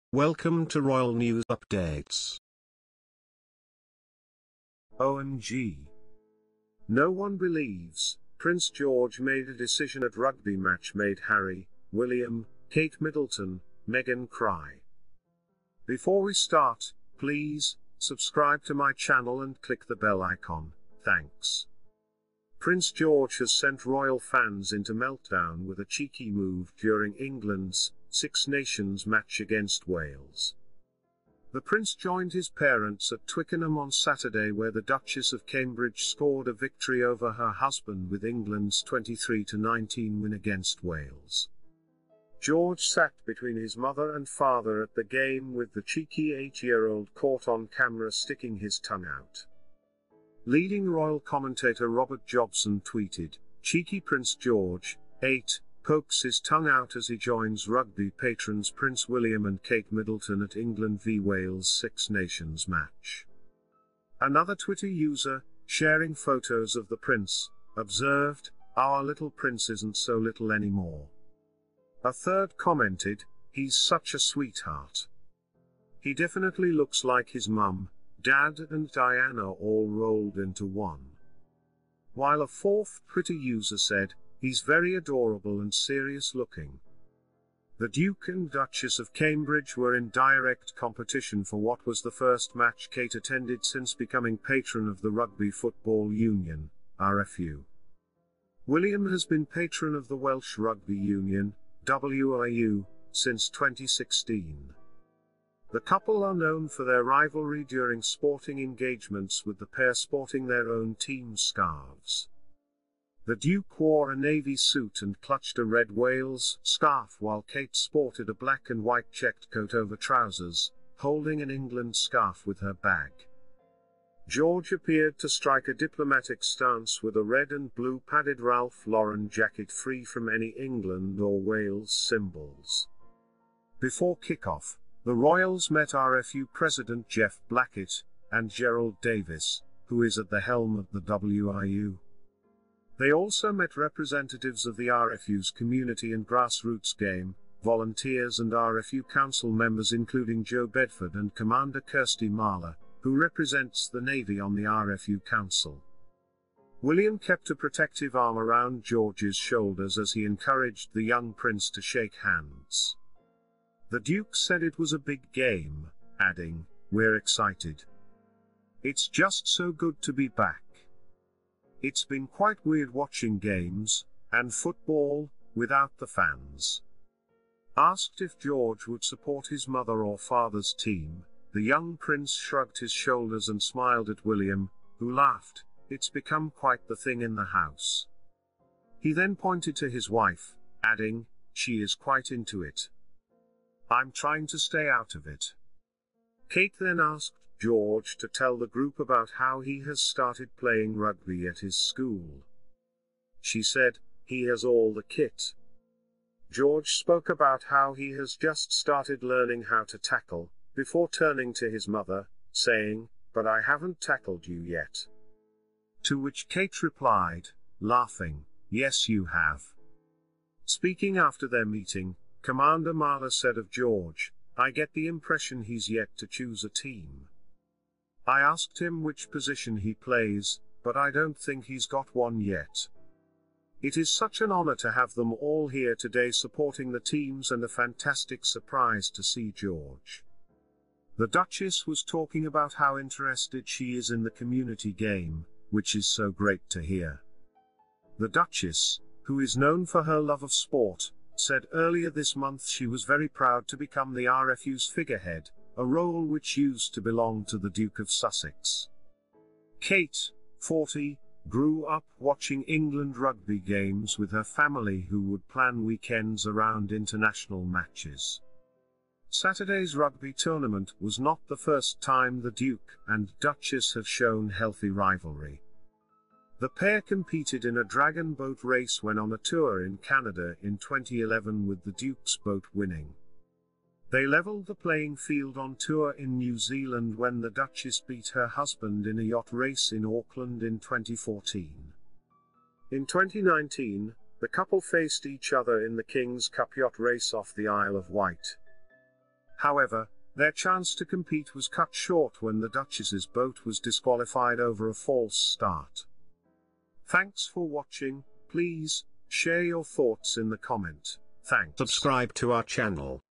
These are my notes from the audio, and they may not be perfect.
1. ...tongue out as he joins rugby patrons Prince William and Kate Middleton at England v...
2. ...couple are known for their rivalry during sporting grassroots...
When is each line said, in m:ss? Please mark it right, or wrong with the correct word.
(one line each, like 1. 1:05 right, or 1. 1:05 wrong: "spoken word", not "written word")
1. 0:56 right
2. 1:45 wrong: "engagements", not "grassroots".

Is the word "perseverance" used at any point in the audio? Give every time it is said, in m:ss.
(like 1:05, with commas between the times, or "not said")
not said.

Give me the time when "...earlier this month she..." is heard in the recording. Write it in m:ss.
4:11.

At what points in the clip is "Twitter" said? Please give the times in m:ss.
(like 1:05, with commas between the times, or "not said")
1:04, 1:23.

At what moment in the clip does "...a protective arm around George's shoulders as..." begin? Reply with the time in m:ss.
2:37.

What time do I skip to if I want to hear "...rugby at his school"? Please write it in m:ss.
3:20.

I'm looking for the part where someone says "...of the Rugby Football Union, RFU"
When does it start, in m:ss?
1:34.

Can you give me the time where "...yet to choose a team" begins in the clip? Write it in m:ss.
3:45.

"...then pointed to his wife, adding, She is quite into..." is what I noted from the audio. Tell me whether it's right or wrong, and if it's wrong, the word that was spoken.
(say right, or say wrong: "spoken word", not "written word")
right.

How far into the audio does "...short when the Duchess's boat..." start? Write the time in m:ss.
5:01.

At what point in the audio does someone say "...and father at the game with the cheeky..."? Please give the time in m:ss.
0:44.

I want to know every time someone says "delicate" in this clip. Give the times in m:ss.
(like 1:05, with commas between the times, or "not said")
not said.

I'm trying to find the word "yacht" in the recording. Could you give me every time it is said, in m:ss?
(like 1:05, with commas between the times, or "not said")
4:49, 4:56.